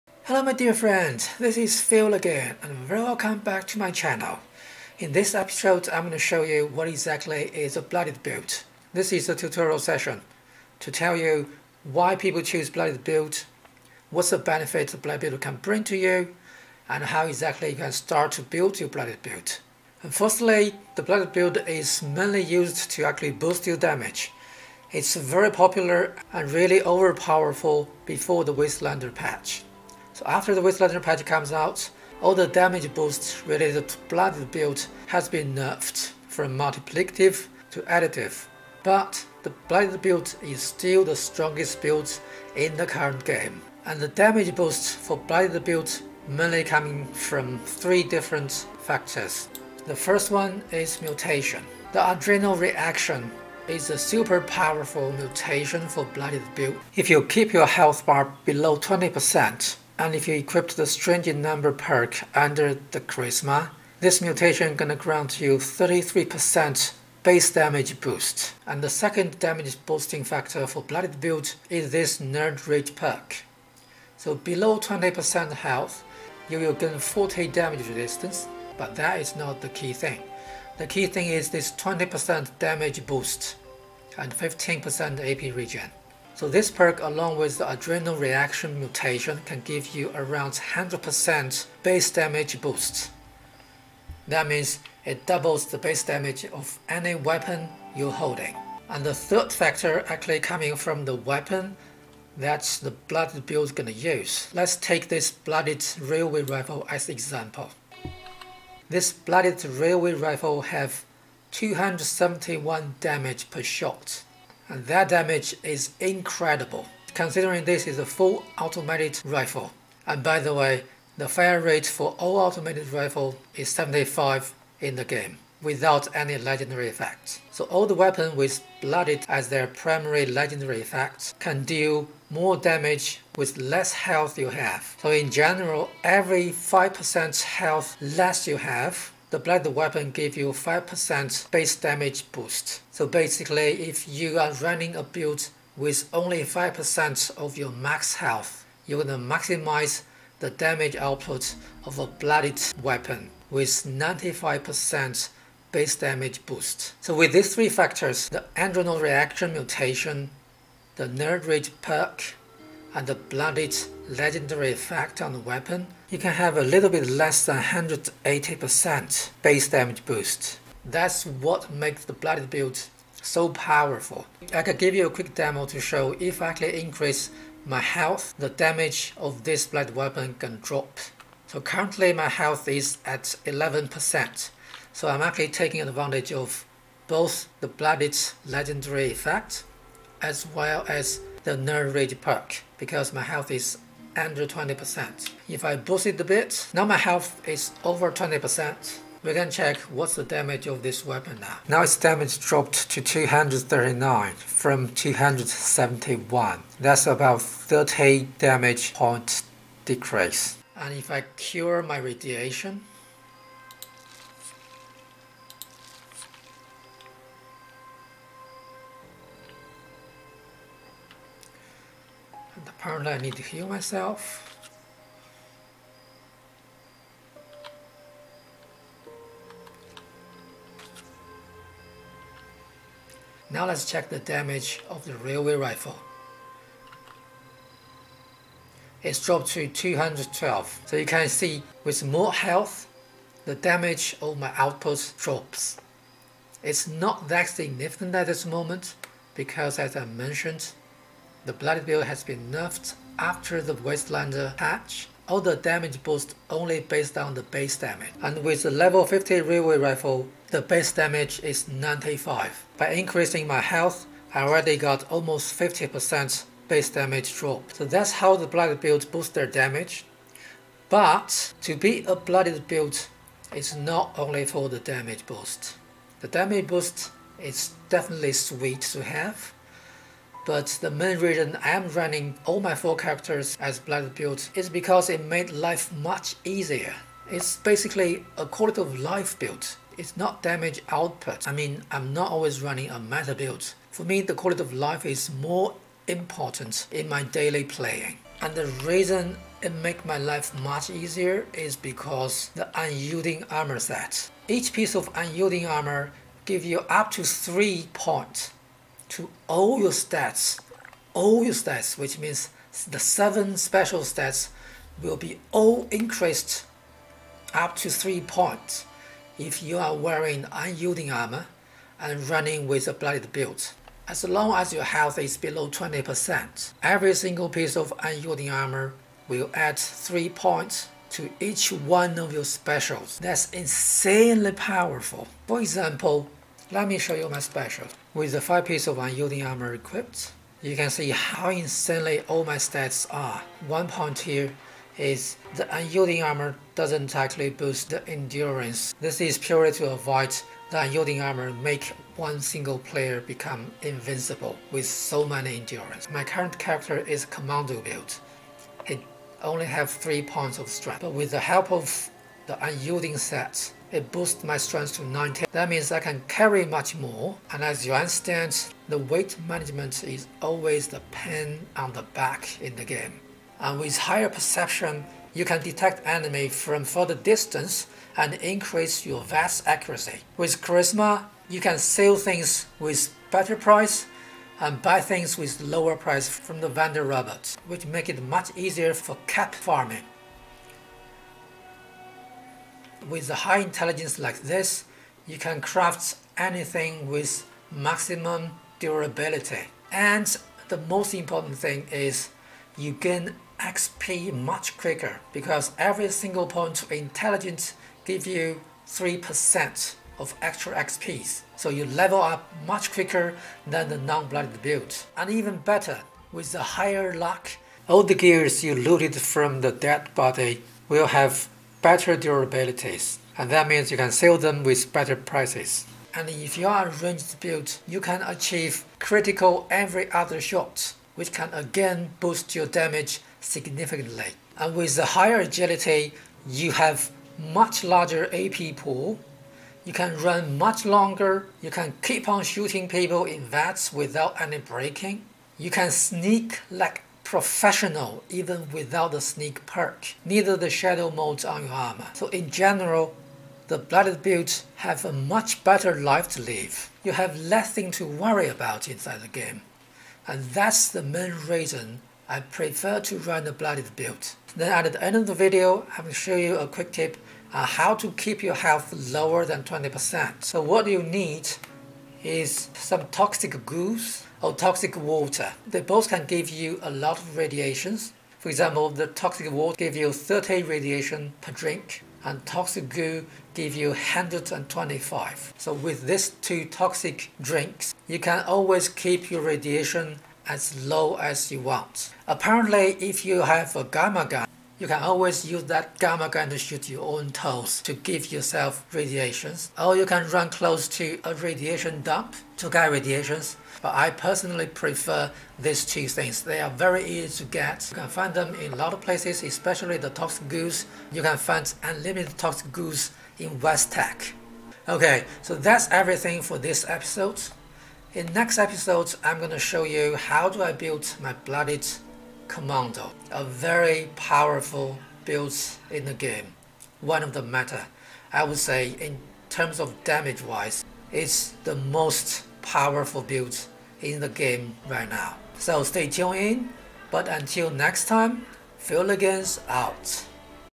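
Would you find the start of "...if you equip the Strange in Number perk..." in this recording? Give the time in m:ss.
1:00.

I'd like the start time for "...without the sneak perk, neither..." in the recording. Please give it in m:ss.
7:28.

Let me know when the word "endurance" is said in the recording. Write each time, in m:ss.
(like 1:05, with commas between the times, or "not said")
5:48, 5:55.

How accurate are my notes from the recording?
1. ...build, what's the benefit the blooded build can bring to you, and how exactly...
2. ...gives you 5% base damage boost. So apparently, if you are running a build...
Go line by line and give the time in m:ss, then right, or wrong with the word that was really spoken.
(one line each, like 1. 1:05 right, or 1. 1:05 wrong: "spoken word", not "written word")
1. 0:13 right
2. 2:20 wrong: "basically", not "apparently".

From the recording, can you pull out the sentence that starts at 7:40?
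And that's the main reason I prefer to run the blooded build.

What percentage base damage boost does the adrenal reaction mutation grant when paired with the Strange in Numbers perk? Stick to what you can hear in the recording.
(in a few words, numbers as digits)
33%.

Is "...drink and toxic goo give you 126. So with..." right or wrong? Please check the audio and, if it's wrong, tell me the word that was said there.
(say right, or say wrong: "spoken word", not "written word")
wrong: "125", not "126".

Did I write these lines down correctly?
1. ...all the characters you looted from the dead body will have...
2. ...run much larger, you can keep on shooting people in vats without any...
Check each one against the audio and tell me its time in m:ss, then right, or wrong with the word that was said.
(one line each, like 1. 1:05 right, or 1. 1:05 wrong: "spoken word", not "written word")
1. 6:57 wrong: "gears", not "characters"
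2. 7:20 wrong: "longer", not "larger".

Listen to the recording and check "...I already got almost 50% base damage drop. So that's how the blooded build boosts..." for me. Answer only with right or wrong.
right.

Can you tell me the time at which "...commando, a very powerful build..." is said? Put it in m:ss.
8:42.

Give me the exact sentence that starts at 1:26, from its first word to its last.
So this perk along with the adrenal reaction mutation can give you around 100% base damage boost.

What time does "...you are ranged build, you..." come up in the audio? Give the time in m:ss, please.
7:06.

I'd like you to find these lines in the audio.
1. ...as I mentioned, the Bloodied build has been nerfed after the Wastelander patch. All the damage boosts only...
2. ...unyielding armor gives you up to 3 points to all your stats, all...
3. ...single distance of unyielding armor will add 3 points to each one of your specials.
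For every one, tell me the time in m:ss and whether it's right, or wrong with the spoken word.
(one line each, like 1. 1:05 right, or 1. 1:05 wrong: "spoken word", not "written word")
1. 4:09 right
2. 5:05 right
3. 5:27 wrong: "piece", not "distance".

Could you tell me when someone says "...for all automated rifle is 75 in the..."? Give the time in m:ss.
2:01.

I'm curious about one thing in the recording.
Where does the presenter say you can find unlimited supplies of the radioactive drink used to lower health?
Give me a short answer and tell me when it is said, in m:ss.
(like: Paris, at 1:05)
West Tek, at 8:33.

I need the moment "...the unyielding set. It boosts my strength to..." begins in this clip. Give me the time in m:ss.
6:02.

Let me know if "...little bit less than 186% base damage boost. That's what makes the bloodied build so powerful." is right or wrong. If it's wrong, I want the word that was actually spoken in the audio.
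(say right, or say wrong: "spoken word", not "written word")
wrong: "180", not "186".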